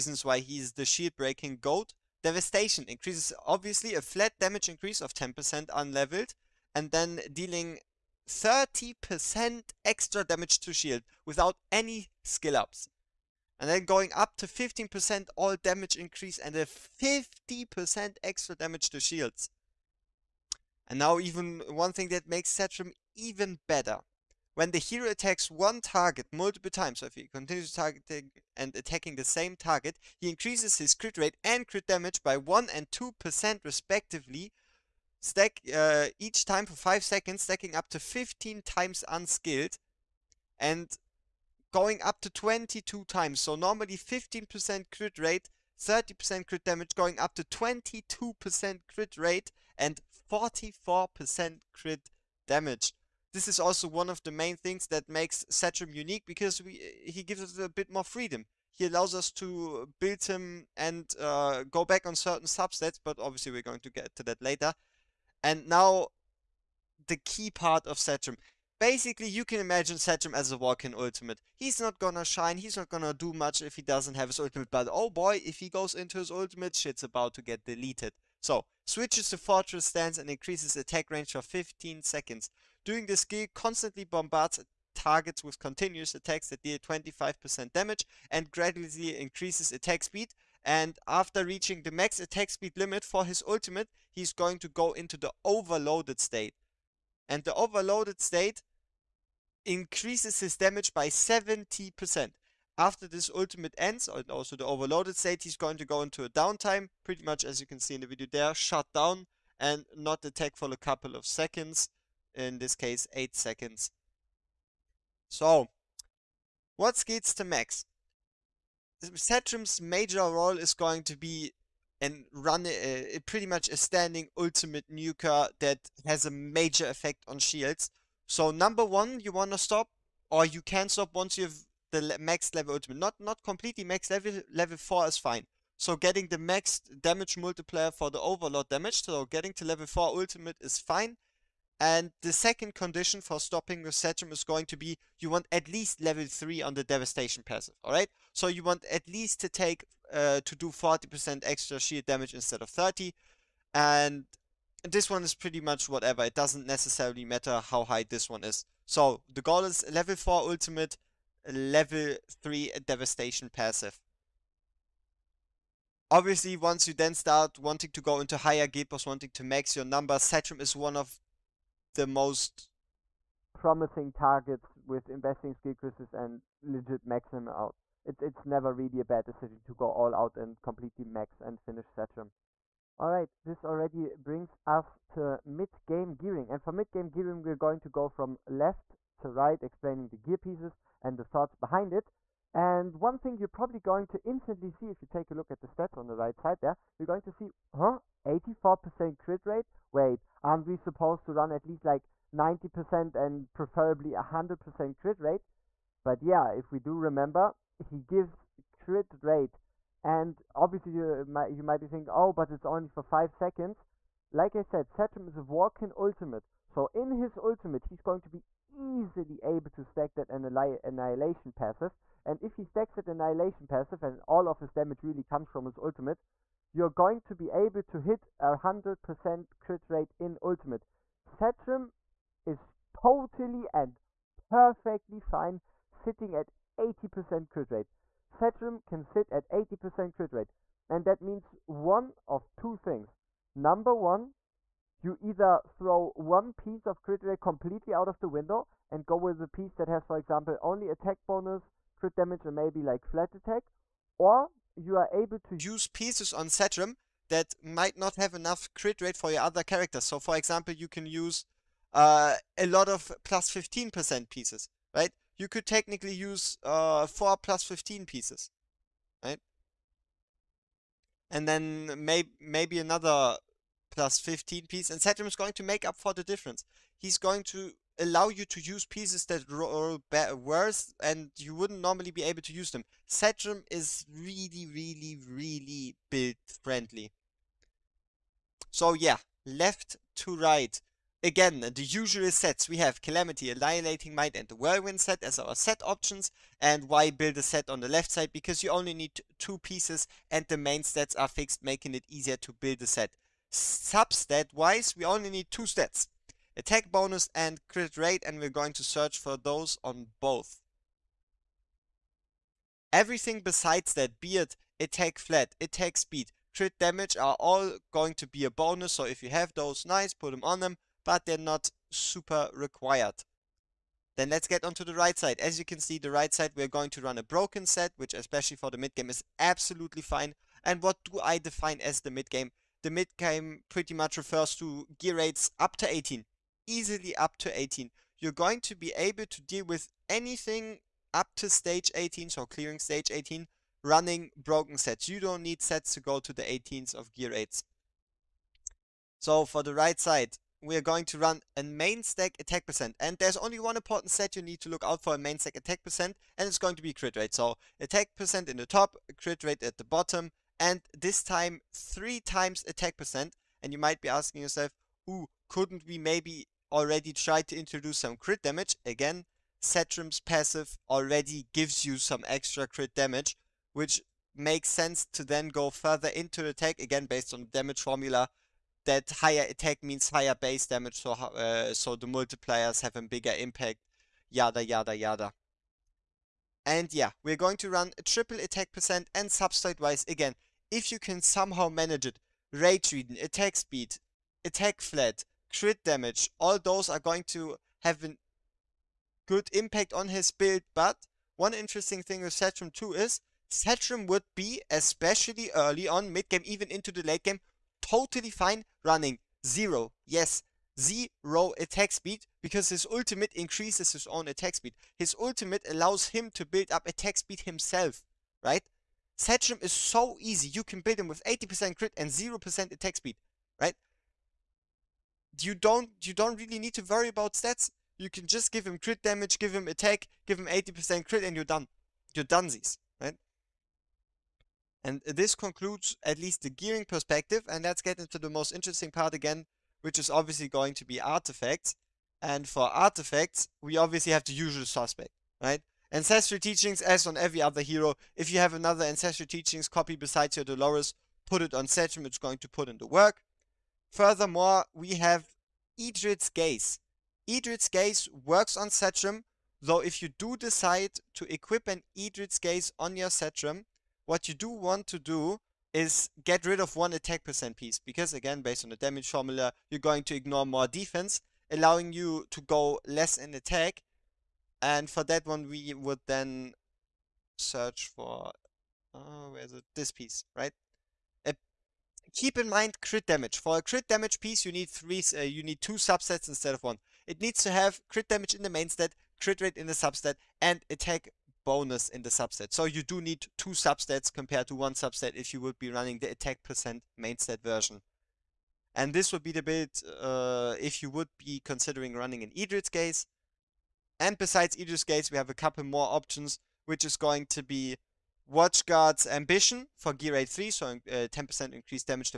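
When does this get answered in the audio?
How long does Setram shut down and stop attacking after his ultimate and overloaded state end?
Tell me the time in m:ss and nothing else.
1:53.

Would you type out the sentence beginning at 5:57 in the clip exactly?
So attack percent in the top, crit rate at the bottom, and this time three times attack percent.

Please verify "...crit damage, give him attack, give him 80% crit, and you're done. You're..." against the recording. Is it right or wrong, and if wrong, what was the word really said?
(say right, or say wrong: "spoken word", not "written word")
right.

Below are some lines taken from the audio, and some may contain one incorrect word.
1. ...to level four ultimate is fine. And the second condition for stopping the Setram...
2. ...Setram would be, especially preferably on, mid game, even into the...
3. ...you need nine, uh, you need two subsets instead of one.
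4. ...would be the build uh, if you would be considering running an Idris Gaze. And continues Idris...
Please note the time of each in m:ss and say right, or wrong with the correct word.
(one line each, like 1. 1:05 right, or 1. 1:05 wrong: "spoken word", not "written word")
1. 2:19 right
2. 6:43 wrong: "early", not "preferably"
3. 8:04 wrong: "three", not "nine"
4. 8:19 wrong: "besides", not "continues".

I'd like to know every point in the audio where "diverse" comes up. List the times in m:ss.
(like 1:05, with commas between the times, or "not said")
not said.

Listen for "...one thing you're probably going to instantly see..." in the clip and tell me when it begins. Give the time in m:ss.
3:12.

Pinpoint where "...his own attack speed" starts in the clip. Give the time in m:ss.
6:53.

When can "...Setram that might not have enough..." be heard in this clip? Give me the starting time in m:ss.
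4:16.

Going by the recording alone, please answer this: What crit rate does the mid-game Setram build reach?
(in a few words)
84%.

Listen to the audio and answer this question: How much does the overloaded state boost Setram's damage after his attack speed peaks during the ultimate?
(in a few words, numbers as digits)
70%.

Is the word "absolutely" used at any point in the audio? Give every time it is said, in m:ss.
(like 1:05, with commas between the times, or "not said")
5:29.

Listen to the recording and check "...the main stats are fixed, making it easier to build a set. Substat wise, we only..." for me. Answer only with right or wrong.
right.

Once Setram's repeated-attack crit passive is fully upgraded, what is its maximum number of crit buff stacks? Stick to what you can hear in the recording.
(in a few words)
22.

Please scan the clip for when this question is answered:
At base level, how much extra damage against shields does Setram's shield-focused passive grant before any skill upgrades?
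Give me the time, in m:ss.
0:08.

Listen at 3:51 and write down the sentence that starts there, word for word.
Setram is totally and perfectly fine sitting at 80% crit rate.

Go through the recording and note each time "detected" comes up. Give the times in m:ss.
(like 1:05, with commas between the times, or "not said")
not said.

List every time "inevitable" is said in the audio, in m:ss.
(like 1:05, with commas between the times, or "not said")
not said.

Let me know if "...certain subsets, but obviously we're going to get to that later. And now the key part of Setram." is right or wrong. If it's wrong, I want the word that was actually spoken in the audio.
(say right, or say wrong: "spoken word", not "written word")
right.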